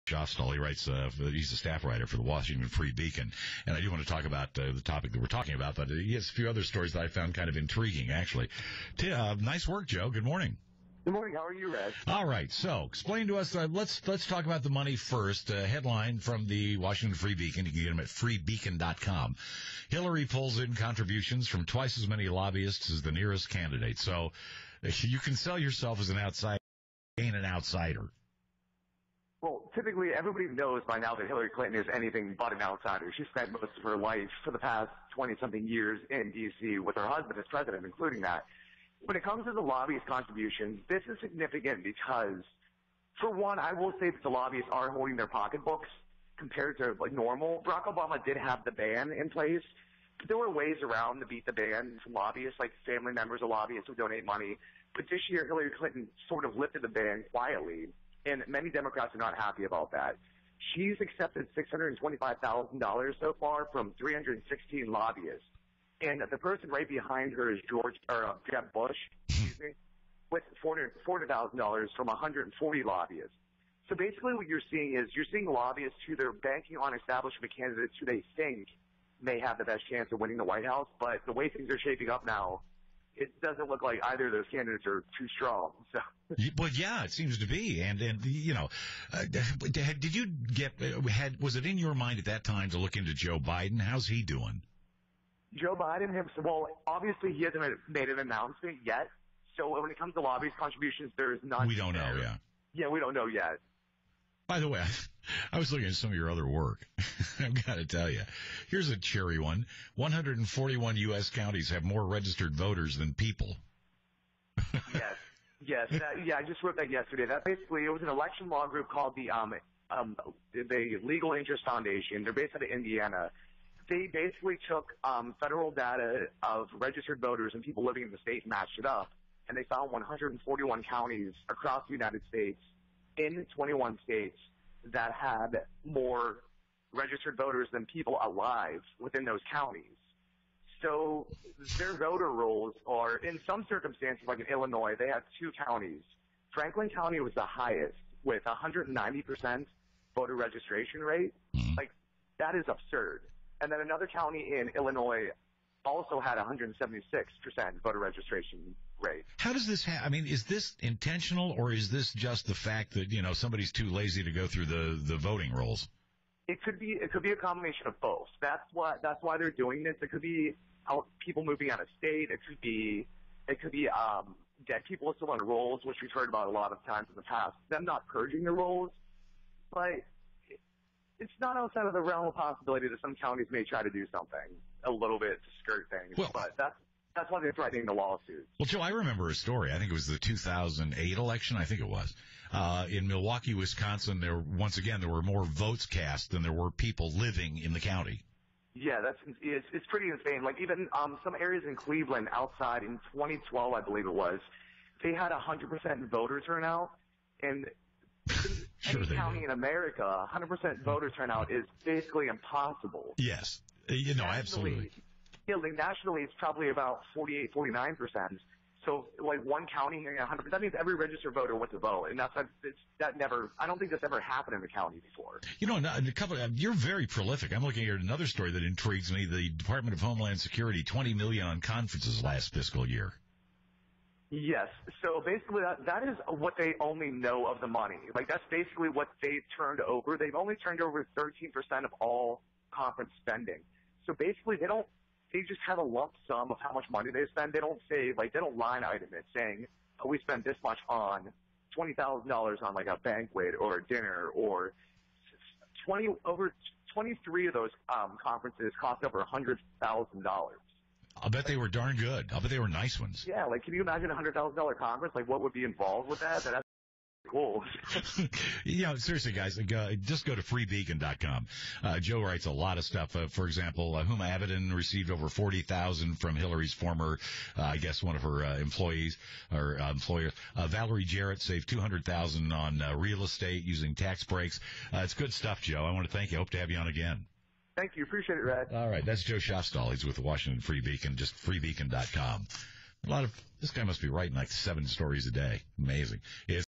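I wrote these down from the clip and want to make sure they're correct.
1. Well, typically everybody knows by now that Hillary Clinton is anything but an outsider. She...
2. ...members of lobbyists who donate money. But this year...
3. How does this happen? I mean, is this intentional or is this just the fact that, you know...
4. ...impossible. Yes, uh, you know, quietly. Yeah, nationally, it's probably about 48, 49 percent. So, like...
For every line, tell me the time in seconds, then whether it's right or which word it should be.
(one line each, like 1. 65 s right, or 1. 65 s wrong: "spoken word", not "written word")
1. 29 s right
2. 53 s right
3. 159 s right
4. 212 s wrong: "absolutely", not "quietly".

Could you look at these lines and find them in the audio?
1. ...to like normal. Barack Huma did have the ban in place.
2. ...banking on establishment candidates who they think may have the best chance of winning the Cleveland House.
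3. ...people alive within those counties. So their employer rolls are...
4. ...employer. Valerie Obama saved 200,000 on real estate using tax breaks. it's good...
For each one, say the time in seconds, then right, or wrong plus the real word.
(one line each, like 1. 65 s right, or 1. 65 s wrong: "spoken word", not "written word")
1. 46 s wrong: "Obama", not "Huma"
2. 76 s wrong: "White", not "Cleveland"
3. 137 s wrong: "voter", not "employer"
4. 279 s wrong: "Jarrett", not "Obama".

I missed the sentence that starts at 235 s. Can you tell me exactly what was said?
So basically, that, that is what they only know of the money.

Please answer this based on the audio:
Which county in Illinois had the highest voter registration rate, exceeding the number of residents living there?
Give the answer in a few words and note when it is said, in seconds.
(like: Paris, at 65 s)
Franklin County, at 146 s.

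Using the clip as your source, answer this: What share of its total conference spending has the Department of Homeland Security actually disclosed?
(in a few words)
13%.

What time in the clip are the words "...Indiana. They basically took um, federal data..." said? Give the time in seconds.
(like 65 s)
122 s.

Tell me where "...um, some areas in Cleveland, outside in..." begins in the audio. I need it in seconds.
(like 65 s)
200 s.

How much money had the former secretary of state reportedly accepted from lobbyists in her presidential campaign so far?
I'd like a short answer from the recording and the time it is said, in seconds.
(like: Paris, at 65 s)
$625,000, at 61 s.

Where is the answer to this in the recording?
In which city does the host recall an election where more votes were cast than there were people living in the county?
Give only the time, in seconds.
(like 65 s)
193 s.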